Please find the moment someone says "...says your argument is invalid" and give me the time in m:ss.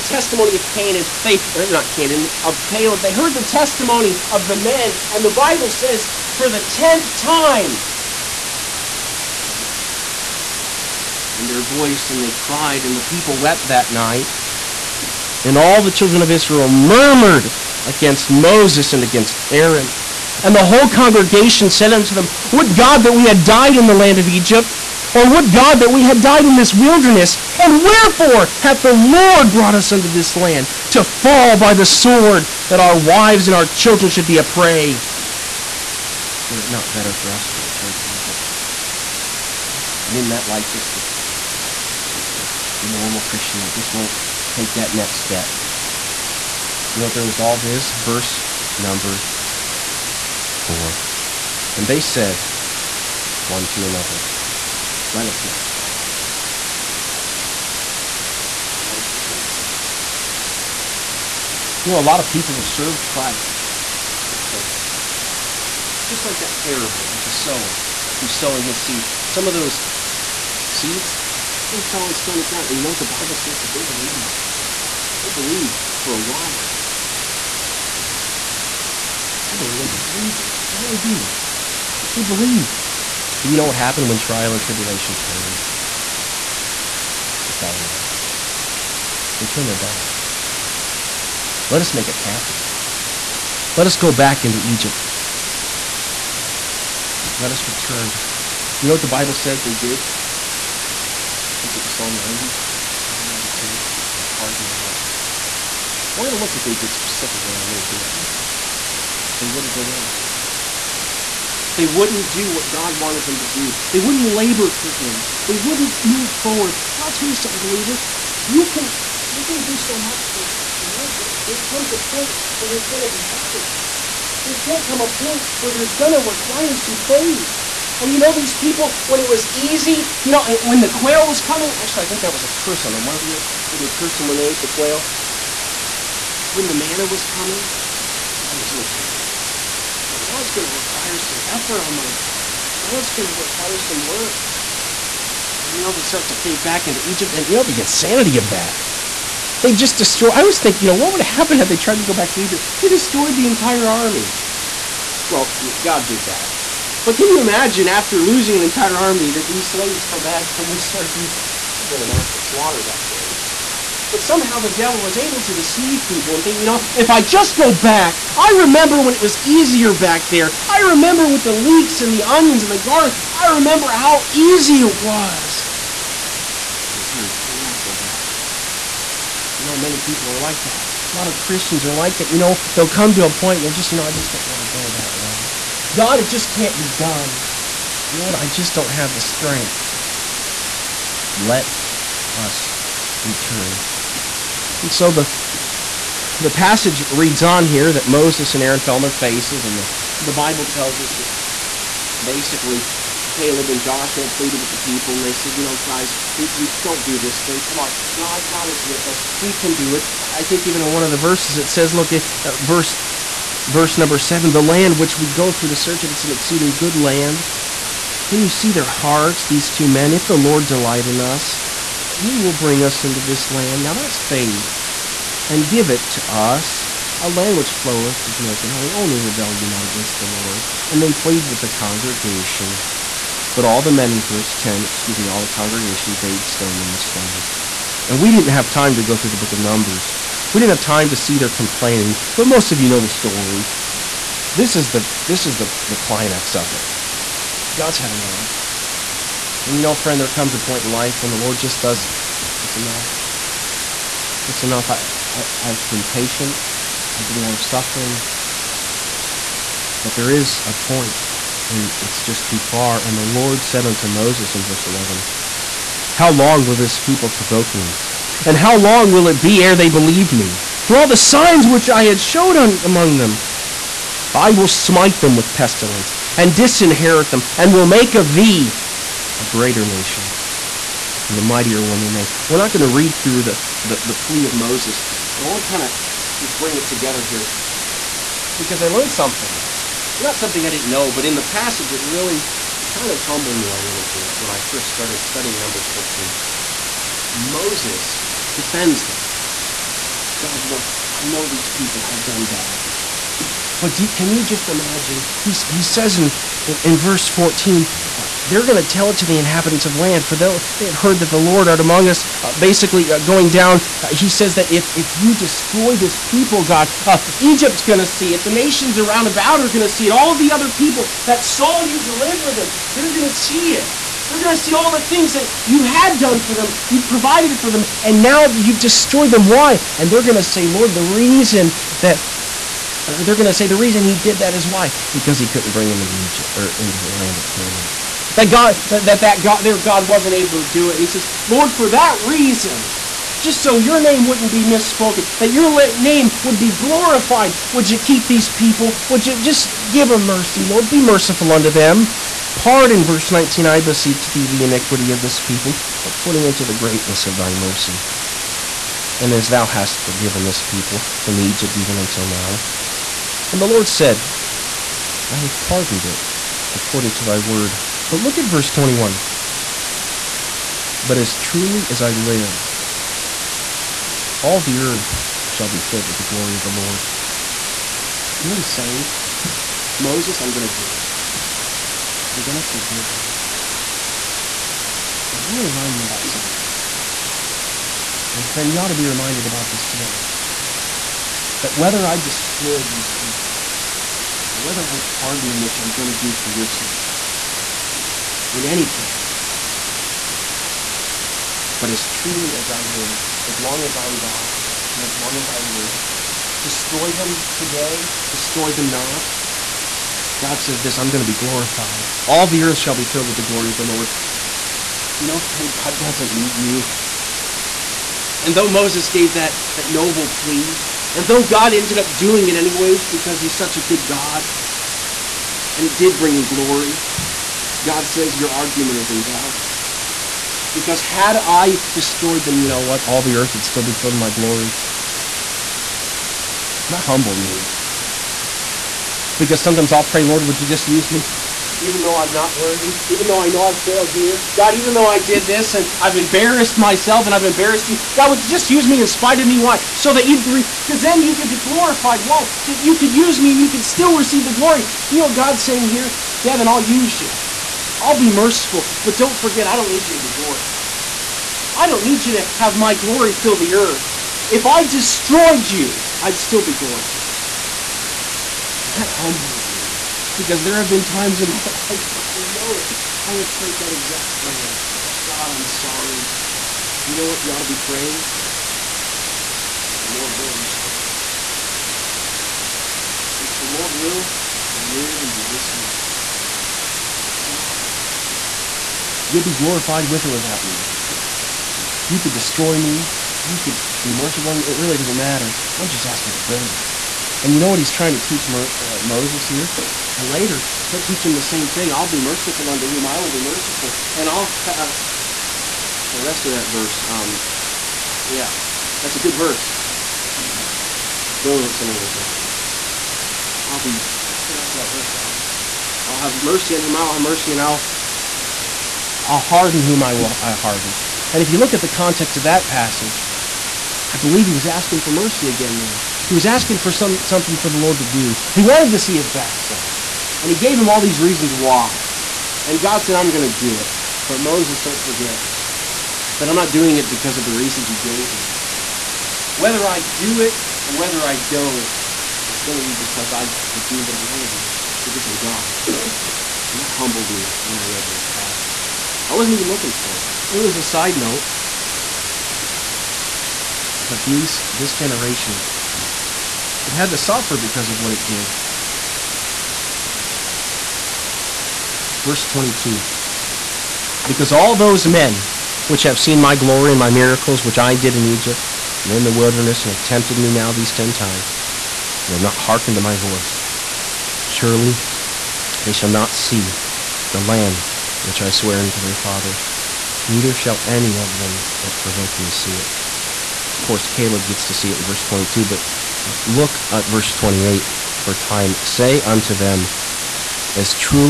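7:08.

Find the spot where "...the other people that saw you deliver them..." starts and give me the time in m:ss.
5:20.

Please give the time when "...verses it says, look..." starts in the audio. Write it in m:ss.
3:31.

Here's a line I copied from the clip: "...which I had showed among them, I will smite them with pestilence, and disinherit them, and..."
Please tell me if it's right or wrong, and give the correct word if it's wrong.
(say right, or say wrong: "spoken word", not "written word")
right.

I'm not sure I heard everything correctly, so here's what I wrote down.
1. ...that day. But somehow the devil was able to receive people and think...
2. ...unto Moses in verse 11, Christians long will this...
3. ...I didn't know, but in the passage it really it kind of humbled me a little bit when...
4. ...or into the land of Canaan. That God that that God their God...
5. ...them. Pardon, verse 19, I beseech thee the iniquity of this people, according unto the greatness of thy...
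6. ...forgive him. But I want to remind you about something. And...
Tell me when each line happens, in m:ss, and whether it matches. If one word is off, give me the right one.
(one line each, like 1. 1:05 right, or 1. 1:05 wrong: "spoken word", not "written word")
1. 2:42 wrong: "deceive", not "receive"
2. 4:23 wrong: "How", not "Christians"
3. 4:50 right
4. 5:36 right
5. 5:51 right
6. 6:22 right.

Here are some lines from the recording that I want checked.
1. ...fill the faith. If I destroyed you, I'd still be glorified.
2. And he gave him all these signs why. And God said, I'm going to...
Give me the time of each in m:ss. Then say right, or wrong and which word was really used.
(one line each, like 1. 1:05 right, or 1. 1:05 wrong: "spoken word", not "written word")
1. 7:43 wrong: "earth", not "faith"
2. 8:50 wrong: "reasons", not "signs".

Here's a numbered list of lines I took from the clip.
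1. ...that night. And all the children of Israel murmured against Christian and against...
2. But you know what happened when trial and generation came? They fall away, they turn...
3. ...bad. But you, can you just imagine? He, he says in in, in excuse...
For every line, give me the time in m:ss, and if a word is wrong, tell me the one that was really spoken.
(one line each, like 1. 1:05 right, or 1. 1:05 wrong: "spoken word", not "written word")
1. 0:13 wrong: "Moses", not "Christian"
2. 1:23 wrong: "tribulation", not "generation"
3. 5:02 wrong: "verse", not "excuse".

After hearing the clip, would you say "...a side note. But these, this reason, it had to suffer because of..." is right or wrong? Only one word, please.
wrong.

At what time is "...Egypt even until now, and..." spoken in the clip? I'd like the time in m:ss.
6:01.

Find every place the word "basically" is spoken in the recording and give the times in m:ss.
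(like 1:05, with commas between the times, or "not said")
3:22, 5:12.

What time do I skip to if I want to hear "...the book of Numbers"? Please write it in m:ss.
3:59.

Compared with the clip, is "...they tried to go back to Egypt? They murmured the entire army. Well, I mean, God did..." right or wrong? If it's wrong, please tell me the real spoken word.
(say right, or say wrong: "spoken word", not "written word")
wrong: "destroyed", not "murmured".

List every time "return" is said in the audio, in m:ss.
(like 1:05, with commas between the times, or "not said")
0:37, 0:59, 1:37, 3:13.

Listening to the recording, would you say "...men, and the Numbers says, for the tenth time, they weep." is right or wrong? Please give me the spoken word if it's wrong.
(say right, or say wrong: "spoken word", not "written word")
wrong: "Bible", not "Numbers".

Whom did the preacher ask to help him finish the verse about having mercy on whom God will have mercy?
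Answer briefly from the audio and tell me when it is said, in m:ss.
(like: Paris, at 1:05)
Al, at 8:35.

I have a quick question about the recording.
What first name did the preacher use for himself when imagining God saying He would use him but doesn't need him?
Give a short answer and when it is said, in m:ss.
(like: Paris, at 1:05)
Devin, at 7:36.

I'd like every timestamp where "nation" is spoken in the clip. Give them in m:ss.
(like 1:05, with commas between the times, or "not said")
4:39, 5:18.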